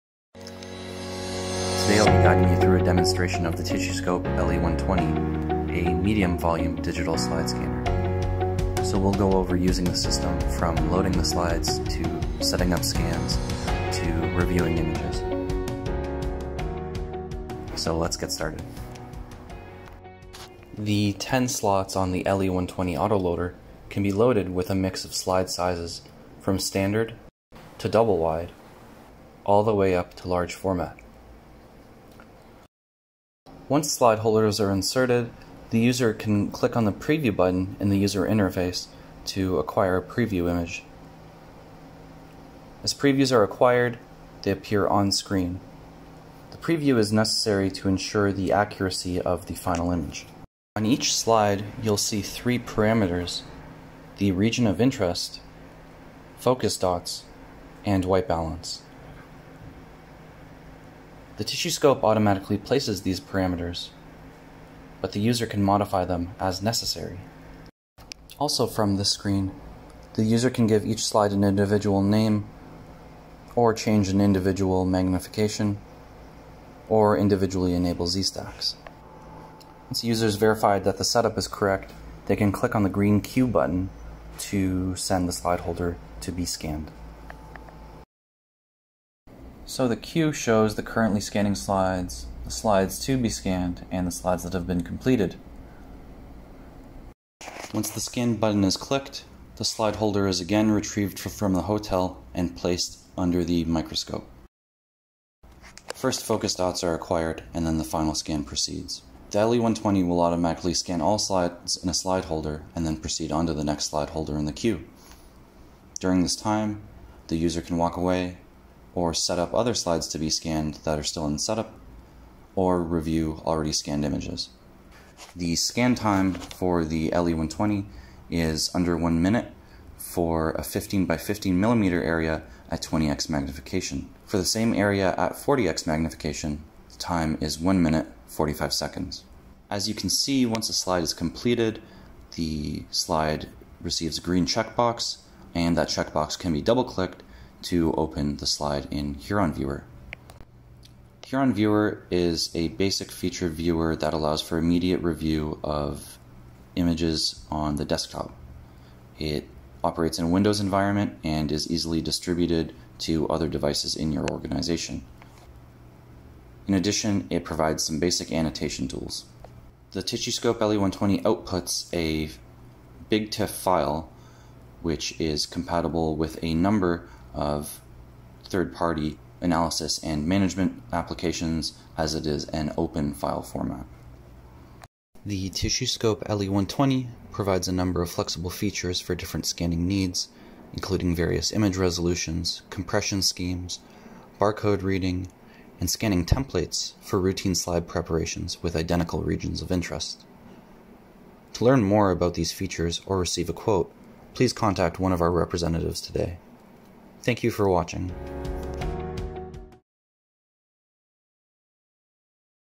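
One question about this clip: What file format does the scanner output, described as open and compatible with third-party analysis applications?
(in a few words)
BigTIFF.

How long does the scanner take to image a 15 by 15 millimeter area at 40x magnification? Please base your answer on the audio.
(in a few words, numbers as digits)
1 minute 45 seconds.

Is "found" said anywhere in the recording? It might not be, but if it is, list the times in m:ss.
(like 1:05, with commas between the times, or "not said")
not said.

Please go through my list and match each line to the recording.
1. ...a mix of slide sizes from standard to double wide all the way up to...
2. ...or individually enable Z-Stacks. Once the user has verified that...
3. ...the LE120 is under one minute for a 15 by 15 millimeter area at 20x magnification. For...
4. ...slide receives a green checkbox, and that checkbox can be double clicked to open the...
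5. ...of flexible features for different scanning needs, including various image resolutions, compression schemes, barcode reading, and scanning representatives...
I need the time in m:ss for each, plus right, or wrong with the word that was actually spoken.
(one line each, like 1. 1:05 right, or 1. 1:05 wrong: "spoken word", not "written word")
1. 0:24 right
2. 1:16 right
3. 2:06 right
4. 2:22 right
5. 3:08 wrong: "templates", not "representatives".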